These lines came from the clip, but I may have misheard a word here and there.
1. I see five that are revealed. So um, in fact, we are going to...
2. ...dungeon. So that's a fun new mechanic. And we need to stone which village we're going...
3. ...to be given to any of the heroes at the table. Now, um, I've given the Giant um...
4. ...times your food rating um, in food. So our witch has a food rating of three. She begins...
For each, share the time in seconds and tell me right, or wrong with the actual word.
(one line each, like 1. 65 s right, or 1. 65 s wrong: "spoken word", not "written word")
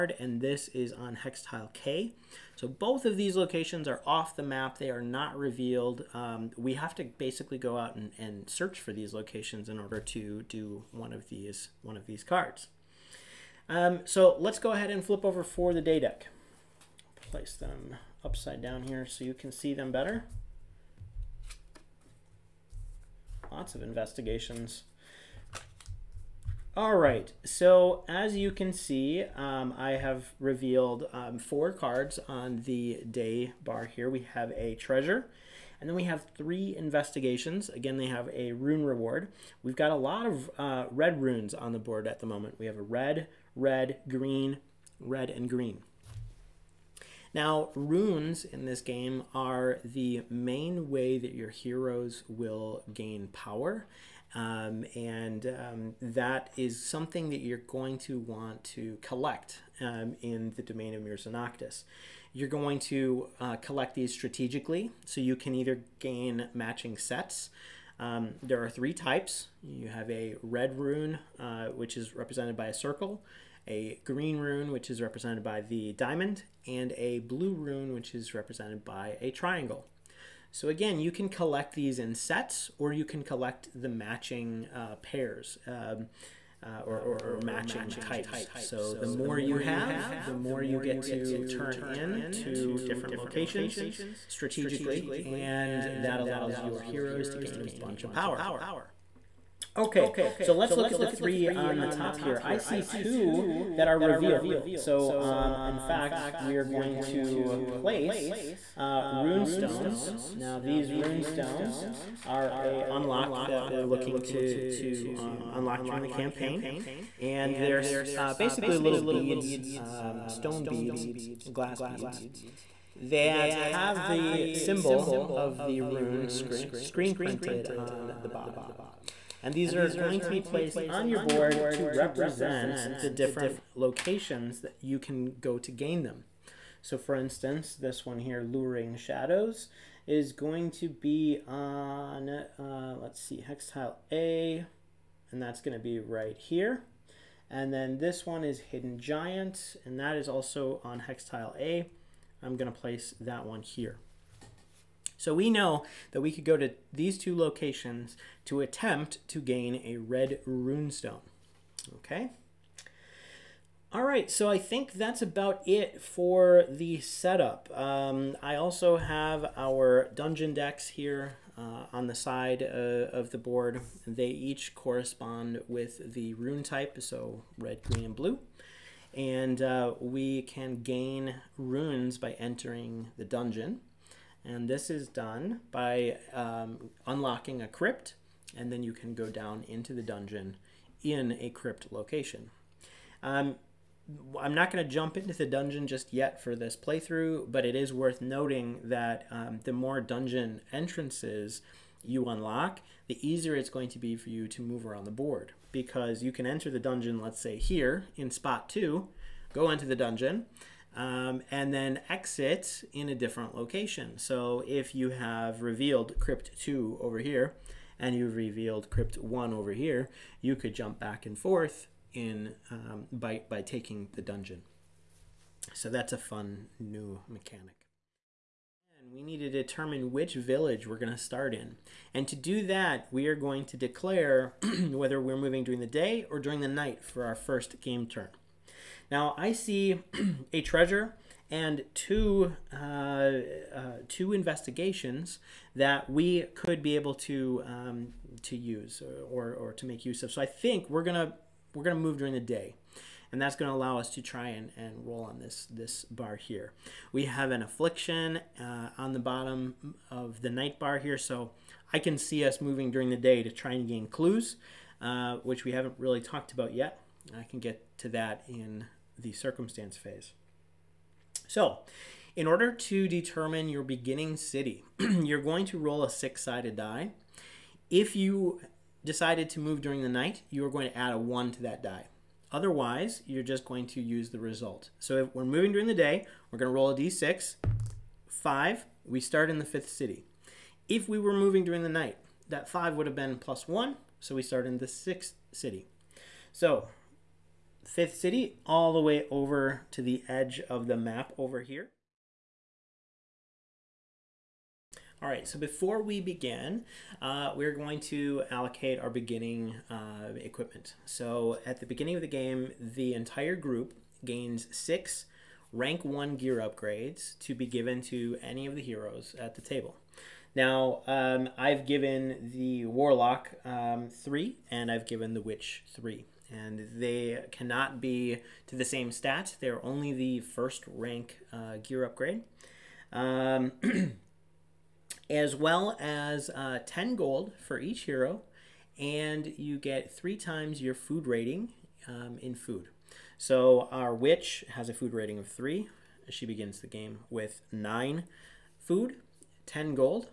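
1. 102 s wrong: "two", not "five"
2. 224 s wrong: "determine", not "stone"
3. 317 s wrong: "Warlock", not "Giant"
4. 340 s right.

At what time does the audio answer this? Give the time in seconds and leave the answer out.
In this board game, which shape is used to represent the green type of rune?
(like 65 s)
75 s.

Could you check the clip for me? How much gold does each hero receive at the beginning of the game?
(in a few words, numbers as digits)
10 gold.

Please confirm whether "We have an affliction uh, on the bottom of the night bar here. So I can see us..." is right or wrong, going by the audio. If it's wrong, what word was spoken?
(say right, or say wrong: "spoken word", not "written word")
right.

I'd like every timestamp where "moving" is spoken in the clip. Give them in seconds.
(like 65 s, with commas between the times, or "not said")
235 s, 262 s, 285 s, 291 s.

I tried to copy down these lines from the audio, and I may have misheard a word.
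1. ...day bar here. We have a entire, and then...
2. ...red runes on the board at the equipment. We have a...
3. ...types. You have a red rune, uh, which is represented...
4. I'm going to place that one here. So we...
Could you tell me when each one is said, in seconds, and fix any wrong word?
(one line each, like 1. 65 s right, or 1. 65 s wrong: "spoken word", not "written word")
1. 33 s wrong: "treasure", not "entire"
2. 40 s wrong: "moment", not "equipment"
3. 68 s right
4. 152 s right.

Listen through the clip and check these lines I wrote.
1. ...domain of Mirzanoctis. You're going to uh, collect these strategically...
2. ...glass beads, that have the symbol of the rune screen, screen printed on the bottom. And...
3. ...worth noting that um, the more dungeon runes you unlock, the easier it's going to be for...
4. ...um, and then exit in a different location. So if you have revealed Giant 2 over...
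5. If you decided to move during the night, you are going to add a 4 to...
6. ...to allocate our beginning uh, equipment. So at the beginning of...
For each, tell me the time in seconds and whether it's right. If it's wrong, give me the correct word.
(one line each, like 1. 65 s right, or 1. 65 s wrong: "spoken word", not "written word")
1. 60 s right
2. 121 s right
3. 197 s wrong: "entrances", not "runes"
4. 210 s wrong: "Crypt", not "Giant"
5. 277 s wrong: "1", not "4"
6. 308 s right.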